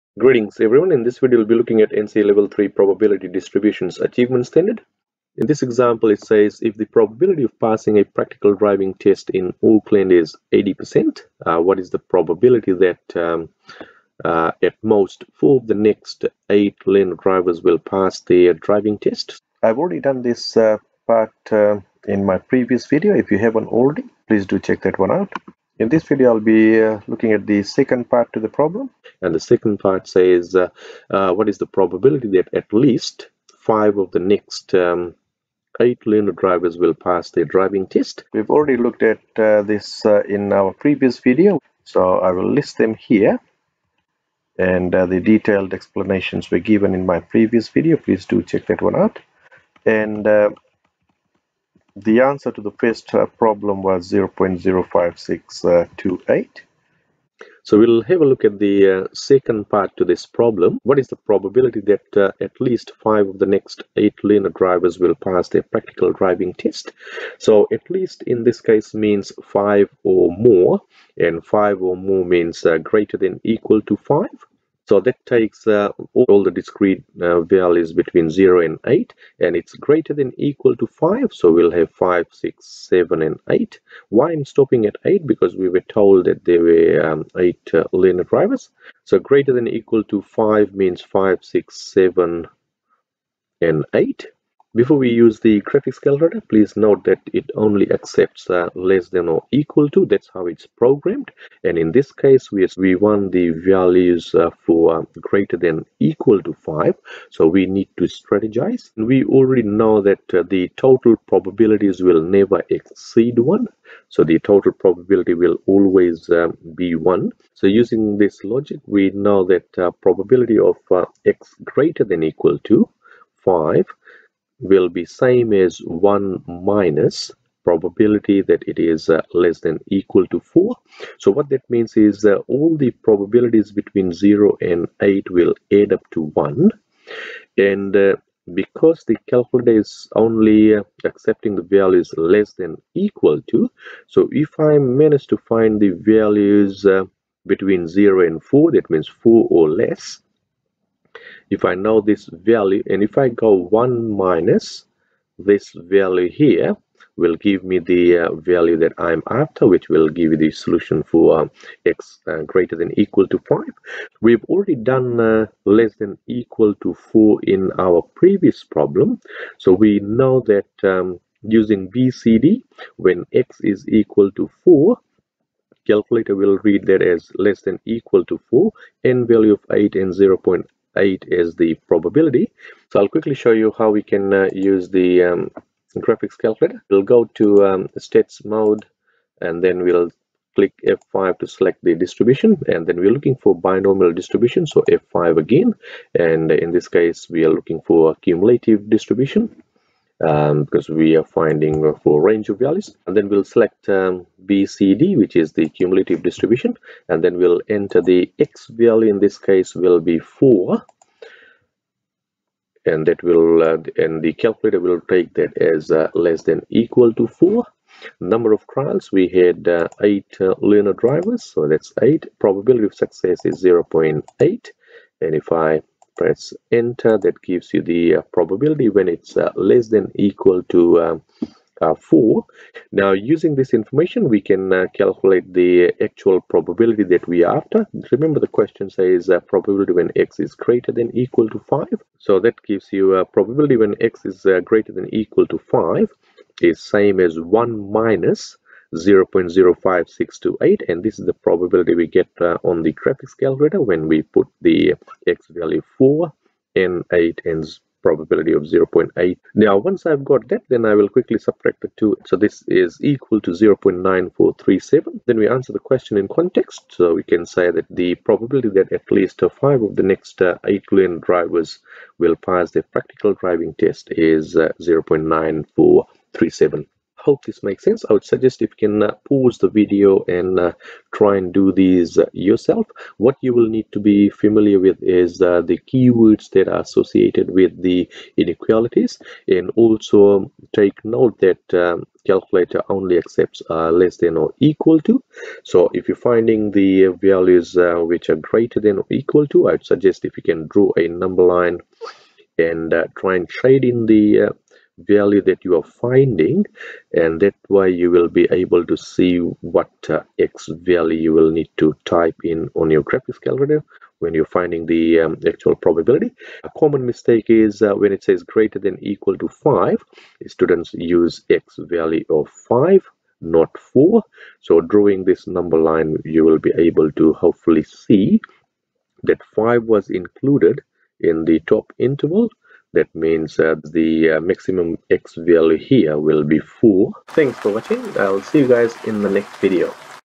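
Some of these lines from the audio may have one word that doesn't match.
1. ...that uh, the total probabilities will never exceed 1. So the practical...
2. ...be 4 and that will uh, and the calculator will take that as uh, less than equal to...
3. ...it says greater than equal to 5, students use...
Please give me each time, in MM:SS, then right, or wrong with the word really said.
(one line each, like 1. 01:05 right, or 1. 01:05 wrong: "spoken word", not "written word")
1. 01:50 wrong: "total", not "practical"
2. 03:29 right
3. 05:18 right.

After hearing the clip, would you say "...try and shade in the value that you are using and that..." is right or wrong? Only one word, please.
wrong.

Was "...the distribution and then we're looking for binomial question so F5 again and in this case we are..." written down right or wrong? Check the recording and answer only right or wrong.
wrong.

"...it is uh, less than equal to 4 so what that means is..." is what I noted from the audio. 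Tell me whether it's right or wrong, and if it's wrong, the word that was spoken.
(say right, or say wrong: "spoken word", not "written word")
right.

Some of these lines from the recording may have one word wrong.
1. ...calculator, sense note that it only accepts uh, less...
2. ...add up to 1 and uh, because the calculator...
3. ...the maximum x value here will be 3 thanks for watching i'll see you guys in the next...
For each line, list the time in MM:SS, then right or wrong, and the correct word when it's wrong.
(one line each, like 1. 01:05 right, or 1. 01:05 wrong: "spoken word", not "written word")
1. 01:36 wrong: "please", not "sense"
2. 02:15 right
3. 05:33 wrong: "4", not "3".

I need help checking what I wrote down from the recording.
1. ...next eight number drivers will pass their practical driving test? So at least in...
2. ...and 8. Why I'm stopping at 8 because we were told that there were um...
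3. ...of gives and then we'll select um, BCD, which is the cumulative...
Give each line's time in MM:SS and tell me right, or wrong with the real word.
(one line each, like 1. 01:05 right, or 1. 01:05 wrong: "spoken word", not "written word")
1. 01:03 wrong: "learner", not "number"
2. 01:23 right
3. 03:22 wrong: "values", not "gives".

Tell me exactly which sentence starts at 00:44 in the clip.
And uh, the detailed explanations were given in my previous video.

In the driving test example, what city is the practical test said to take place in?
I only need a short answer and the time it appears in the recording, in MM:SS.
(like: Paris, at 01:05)
Auckland, at 00:09.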